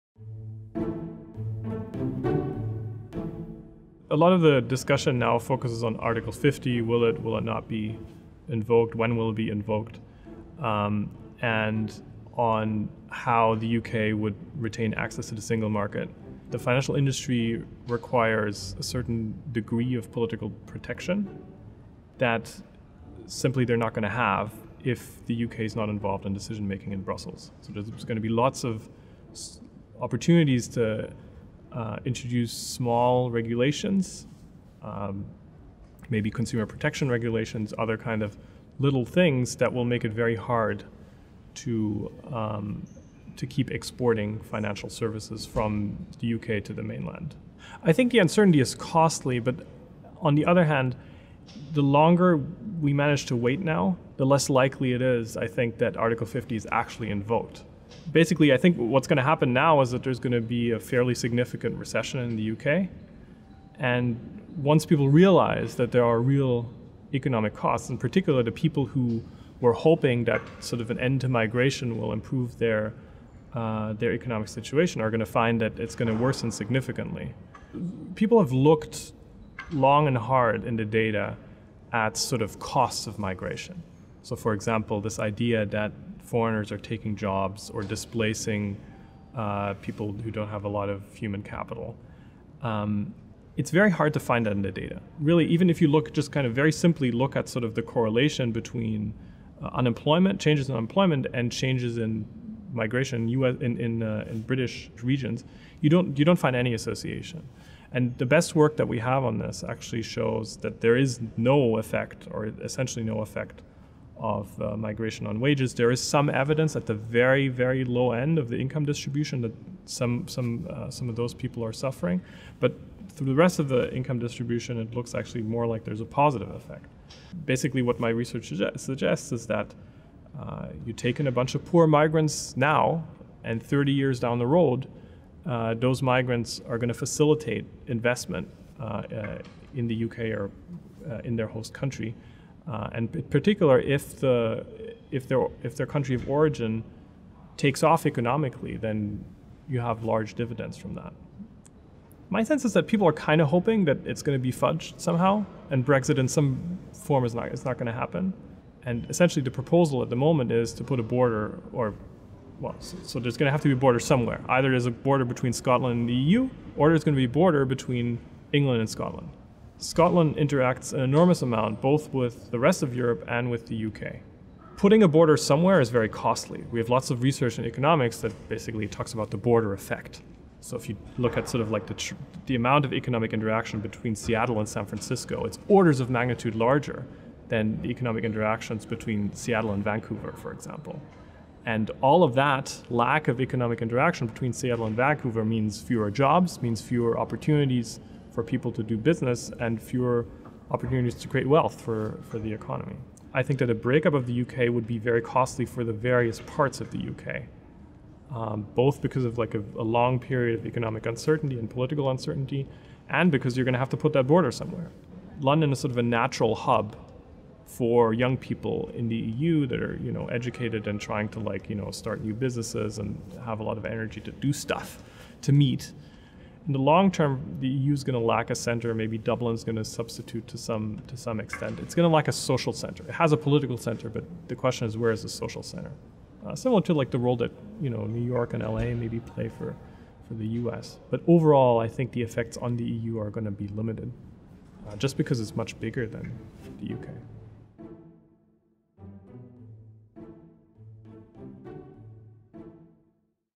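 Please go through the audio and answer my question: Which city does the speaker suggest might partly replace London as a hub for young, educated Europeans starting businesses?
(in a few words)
Dublin.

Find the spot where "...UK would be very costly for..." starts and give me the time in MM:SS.
03:24.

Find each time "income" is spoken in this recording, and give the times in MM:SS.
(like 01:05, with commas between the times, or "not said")
01:58, 02:03.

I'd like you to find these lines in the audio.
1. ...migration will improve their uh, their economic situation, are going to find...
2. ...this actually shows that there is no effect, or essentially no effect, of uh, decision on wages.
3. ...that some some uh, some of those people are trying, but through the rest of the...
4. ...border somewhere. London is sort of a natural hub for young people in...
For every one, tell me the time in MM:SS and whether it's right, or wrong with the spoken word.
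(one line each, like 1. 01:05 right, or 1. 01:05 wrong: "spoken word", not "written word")
1. 01:11 right
2. 01:49 wrong: "migration", not "decision"
3. 01:59 wrong: "suffering", not "trying"
4. 03:34 right.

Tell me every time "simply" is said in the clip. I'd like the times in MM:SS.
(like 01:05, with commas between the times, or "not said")
00:23, 01:36.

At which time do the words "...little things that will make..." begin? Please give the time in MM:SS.
00:38.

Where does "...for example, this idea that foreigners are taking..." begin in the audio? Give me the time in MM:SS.
01:24.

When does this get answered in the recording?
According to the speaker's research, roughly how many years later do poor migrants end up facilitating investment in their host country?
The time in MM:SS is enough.
02:13.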